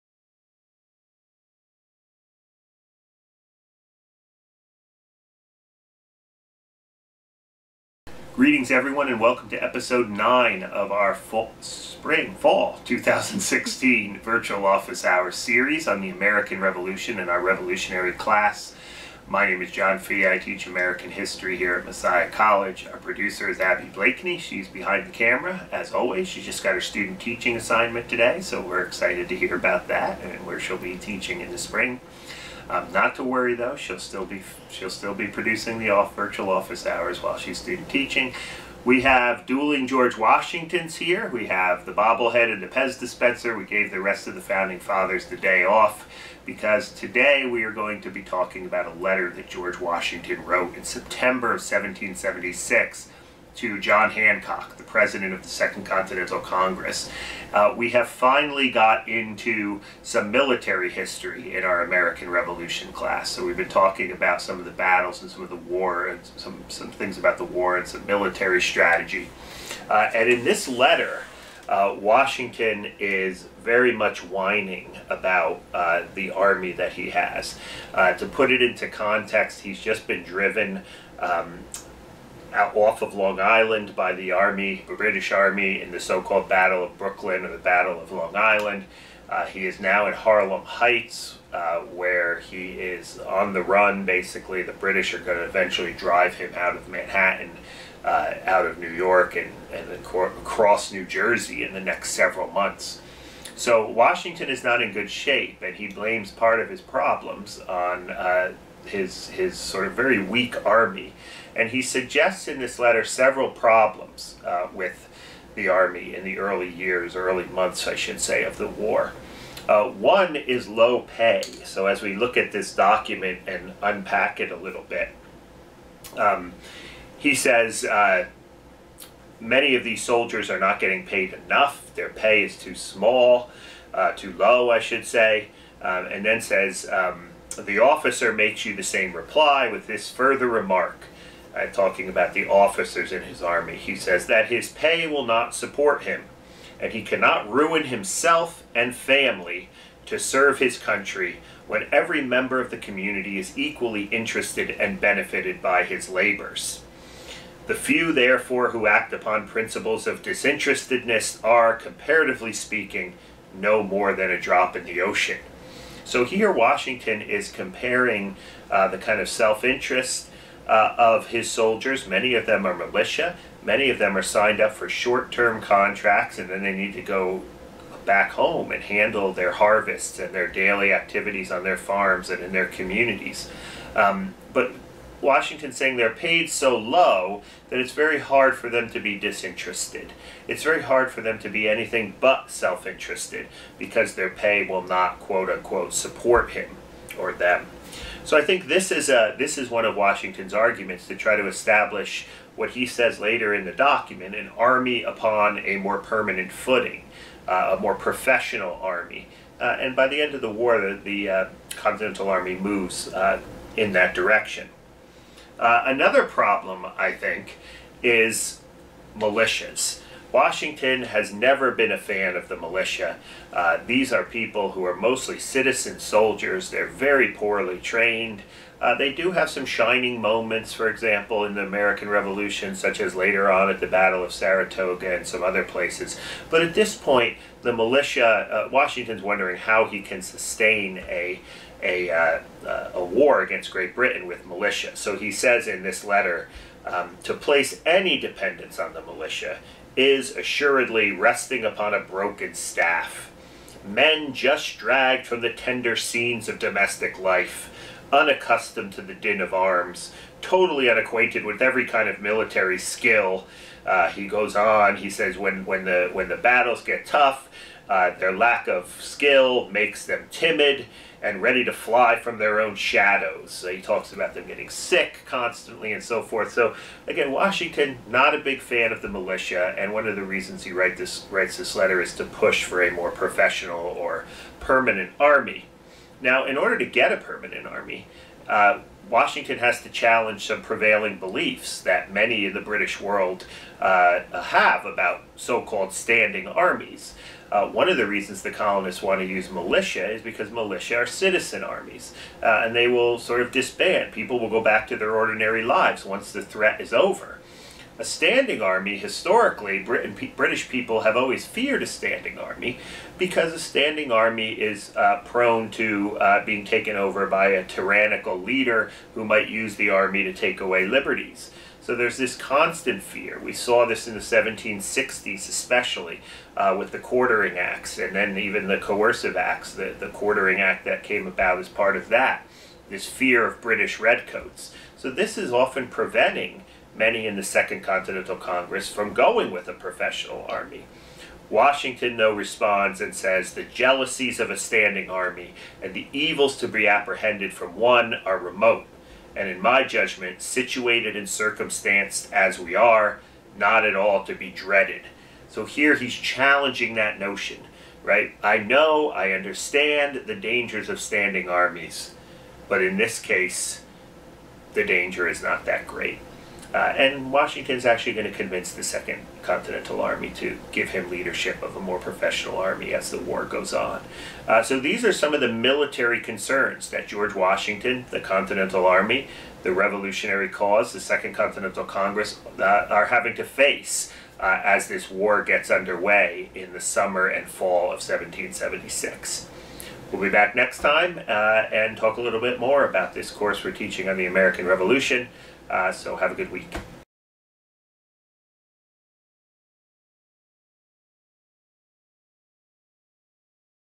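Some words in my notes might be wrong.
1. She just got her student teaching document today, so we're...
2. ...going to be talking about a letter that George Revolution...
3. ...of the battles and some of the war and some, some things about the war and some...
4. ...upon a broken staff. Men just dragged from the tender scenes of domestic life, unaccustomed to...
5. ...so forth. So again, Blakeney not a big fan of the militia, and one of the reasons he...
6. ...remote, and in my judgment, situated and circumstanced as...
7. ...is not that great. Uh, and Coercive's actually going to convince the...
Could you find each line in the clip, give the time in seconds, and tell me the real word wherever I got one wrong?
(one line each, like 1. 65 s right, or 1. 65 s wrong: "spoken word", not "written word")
1. 26 s wrong: "assignment", not "document"
2. 47 s wrong: "Washington", not "Revolution"
3. 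64 s right
4. 251 s right
5. 276 s wrong: "Washington", not "Blakeney"
6. 348 s right
7. 365 s wrong: "Washington", not "Coercive".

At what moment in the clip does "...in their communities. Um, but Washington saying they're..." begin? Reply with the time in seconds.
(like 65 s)
182 s.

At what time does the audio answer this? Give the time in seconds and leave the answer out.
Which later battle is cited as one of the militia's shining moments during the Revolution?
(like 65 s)
233 s.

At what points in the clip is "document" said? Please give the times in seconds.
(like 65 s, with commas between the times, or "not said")
122 s, 203 s.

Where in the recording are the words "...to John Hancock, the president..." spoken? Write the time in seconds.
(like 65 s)
53 s.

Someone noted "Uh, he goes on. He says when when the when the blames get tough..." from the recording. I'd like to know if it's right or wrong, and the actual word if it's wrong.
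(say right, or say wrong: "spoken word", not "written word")
wrong: "battles", not "blames".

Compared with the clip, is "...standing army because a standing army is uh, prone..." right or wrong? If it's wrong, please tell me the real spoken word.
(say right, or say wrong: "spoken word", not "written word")
right.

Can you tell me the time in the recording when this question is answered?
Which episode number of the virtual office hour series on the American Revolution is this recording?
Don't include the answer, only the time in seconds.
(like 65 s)
9 s.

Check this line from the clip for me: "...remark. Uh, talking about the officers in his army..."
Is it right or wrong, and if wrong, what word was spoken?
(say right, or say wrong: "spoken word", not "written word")
right.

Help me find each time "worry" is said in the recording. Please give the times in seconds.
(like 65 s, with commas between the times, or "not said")
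33 s.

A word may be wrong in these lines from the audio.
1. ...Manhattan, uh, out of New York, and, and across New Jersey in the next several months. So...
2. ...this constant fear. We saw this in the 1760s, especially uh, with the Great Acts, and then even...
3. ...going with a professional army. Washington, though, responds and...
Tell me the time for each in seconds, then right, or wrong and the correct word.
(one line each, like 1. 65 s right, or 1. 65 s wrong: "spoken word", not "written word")
1. 96 s right
2. 322 s wrong: "Quartering", not "Great"
3. 339 s right.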